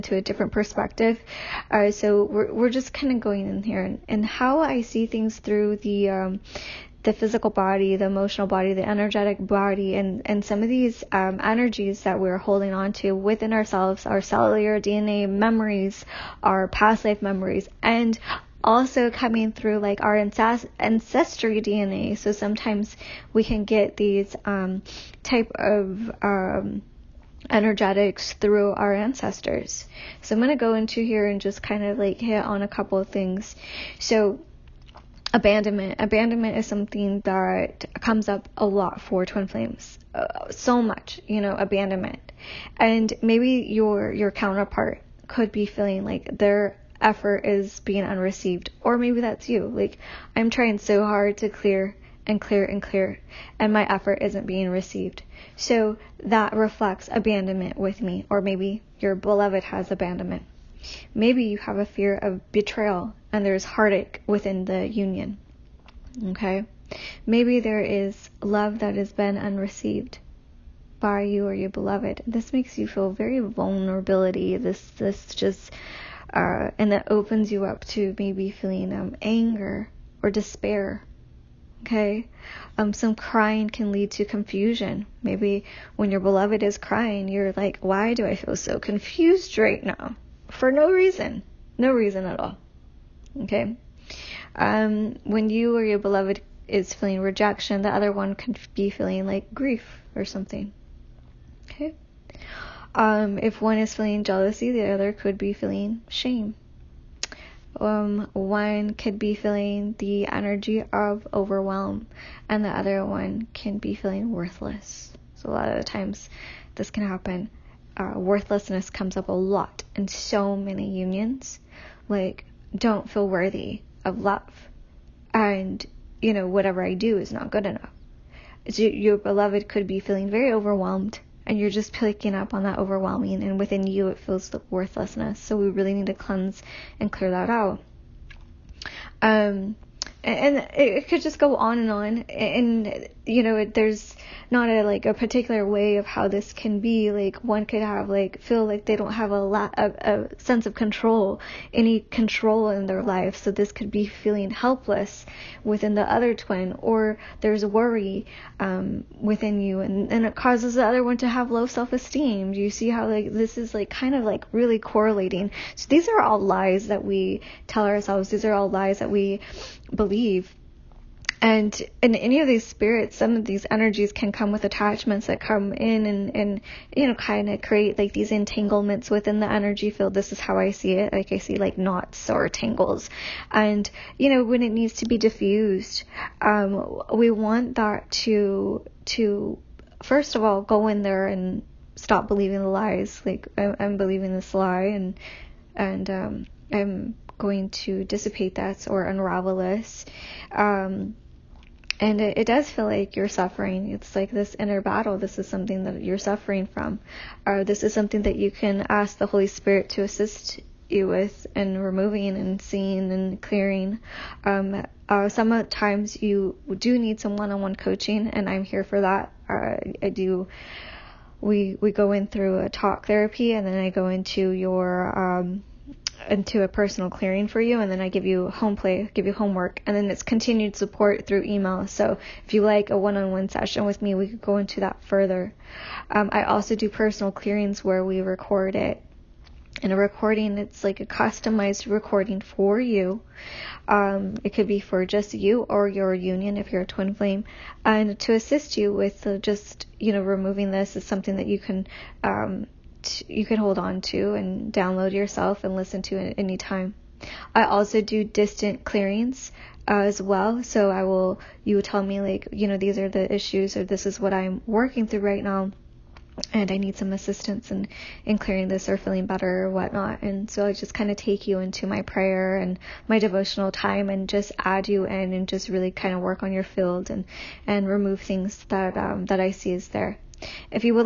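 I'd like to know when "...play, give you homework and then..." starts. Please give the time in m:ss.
3:48.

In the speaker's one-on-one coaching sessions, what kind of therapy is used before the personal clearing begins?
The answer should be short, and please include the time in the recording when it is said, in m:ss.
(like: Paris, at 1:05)
Talk therapy, at 3:42.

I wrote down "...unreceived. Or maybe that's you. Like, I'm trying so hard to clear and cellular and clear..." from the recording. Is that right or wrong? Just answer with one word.
wrong.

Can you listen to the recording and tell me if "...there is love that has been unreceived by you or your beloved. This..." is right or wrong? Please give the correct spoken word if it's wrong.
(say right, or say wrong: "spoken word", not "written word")
right.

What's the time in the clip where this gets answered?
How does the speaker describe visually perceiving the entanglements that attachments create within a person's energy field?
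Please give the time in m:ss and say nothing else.
3:01.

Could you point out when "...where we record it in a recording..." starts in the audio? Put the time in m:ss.
3:57.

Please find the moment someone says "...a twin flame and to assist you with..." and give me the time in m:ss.
4:06.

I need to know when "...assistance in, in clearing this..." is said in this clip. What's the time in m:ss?
4:27.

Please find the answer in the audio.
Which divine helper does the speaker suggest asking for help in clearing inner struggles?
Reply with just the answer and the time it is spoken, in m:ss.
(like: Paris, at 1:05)
The Holy Spirit, at 3:29.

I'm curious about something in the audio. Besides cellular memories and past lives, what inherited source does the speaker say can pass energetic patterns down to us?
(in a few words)
Ancestry DNA.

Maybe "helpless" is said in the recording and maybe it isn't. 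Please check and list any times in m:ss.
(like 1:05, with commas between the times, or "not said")
2:34.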